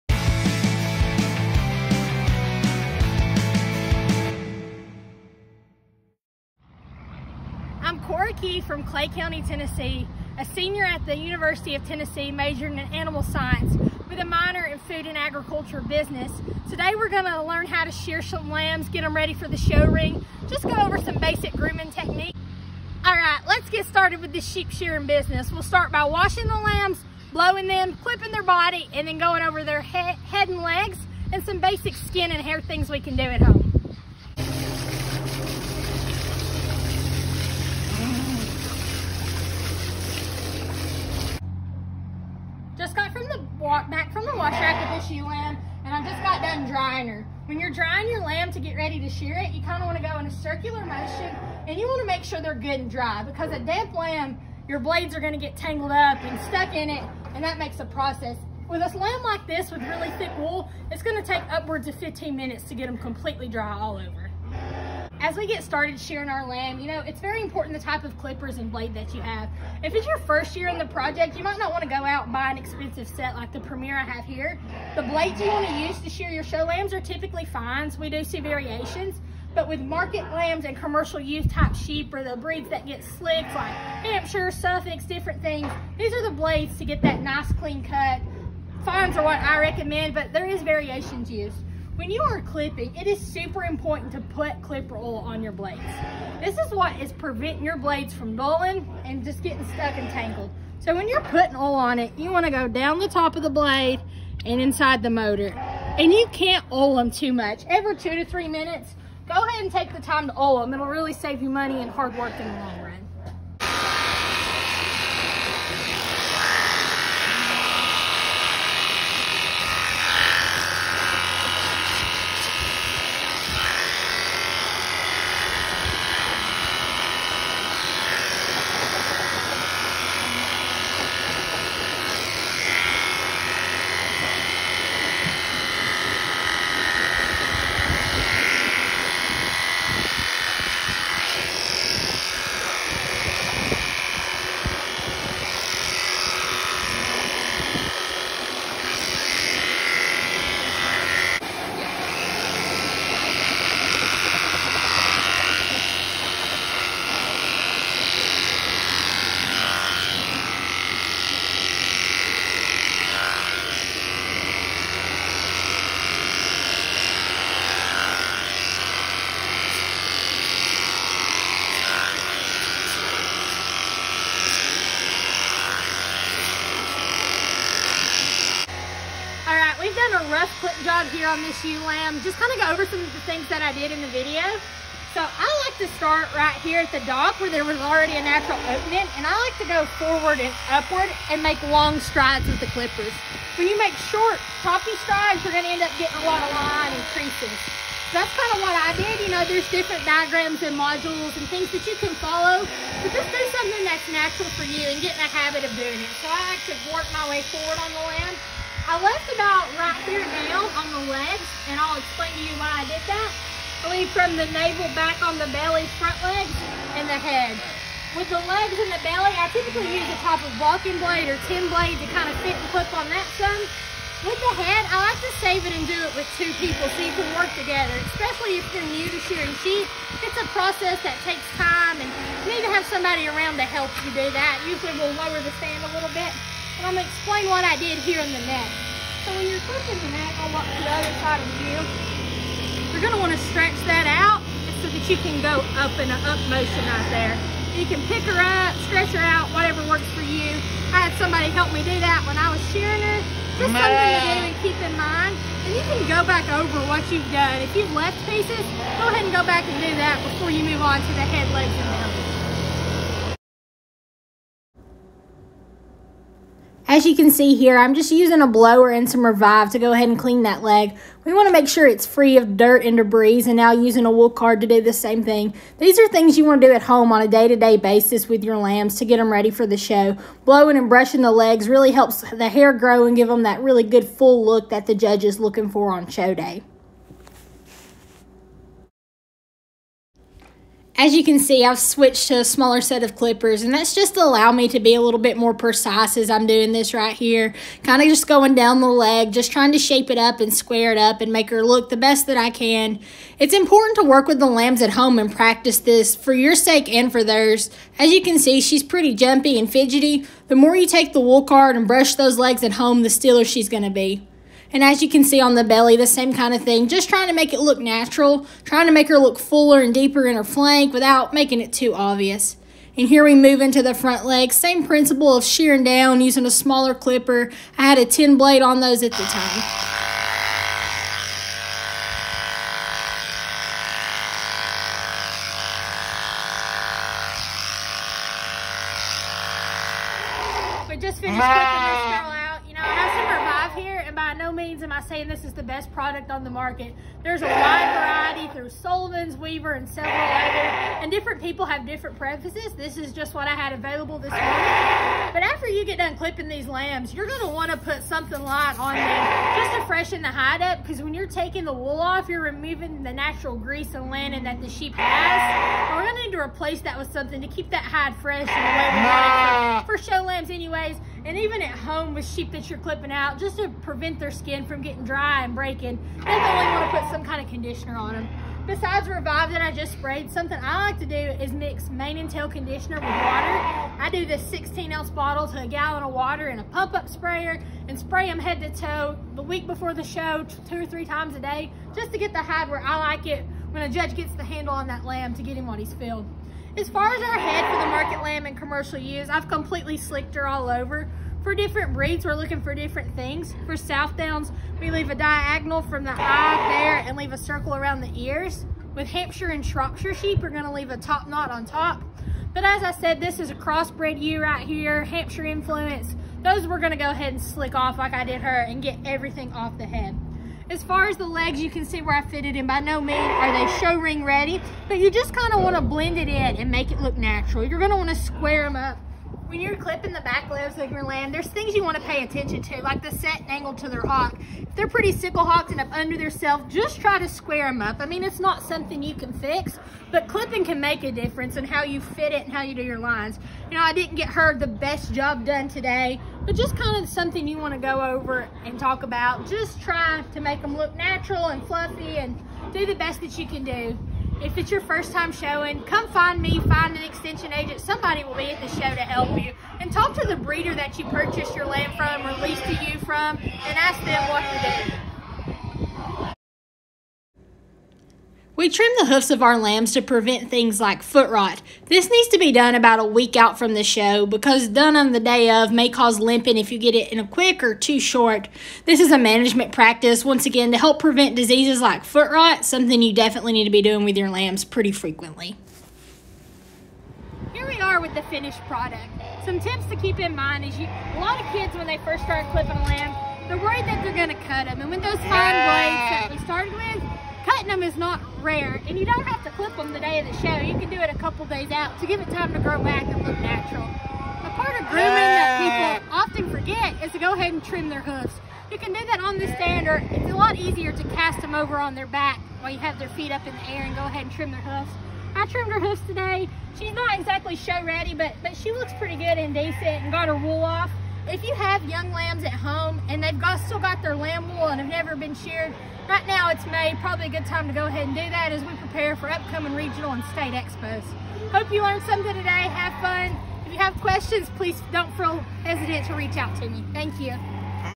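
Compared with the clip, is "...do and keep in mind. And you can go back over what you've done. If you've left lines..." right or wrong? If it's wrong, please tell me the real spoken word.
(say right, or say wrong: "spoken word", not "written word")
wrong: "pieces", not "lines".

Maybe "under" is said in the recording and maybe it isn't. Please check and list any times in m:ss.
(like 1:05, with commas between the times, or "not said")
7:15.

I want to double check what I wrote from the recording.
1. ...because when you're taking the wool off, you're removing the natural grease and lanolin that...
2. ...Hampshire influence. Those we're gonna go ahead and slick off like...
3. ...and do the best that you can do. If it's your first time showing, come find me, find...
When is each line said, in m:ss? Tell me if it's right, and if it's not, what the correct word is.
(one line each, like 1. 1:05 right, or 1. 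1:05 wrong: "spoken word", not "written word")
1. 6:00 right
2. 6:55 right
3. 7:32 right.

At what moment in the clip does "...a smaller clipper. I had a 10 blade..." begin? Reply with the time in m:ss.
5:26.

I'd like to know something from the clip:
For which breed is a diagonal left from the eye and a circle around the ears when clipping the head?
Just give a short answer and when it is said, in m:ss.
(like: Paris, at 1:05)
Southdowns, at 6:43.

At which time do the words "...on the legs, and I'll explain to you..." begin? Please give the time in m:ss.
3:30.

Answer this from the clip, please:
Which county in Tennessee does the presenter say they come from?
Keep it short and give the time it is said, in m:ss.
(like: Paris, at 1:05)
Clay County, at 0:08.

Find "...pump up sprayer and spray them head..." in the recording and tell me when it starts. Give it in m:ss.
6:26.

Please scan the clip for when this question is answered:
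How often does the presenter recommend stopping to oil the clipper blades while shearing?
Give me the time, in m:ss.
1:47.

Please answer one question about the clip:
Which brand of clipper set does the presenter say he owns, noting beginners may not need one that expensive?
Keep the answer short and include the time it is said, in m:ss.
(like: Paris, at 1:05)
Premier, at 1:13.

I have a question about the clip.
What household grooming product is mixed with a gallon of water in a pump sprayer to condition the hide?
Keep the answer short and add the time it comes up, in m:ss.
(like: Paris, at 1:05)
Mane and tail conditioner, at 6:21.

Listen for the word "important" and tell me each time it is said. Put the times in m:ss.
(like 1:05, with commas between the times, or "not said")
1:07, 1:33, 5:03.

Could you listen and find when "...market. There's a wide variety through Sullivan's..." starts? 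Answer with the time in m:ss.
5:46.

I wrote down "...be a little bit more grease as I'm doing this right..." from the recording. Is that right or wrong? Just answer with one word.
wrong.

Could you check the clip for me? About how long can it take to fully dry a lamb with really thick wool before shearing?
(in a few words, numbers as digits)
15 minutes.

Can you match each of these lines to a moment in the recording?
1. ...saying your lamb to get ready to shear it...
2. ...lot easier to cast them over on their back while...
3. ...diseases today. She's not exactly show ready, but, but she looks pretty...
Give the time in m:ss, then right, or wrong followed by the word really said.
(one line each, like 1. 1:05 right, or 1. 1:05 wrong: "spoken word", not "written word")
1. 0:47 wrong: "drying", not "saying"
2. 8:30 right
3. 8:35 wrong: "hooves", not "diseases".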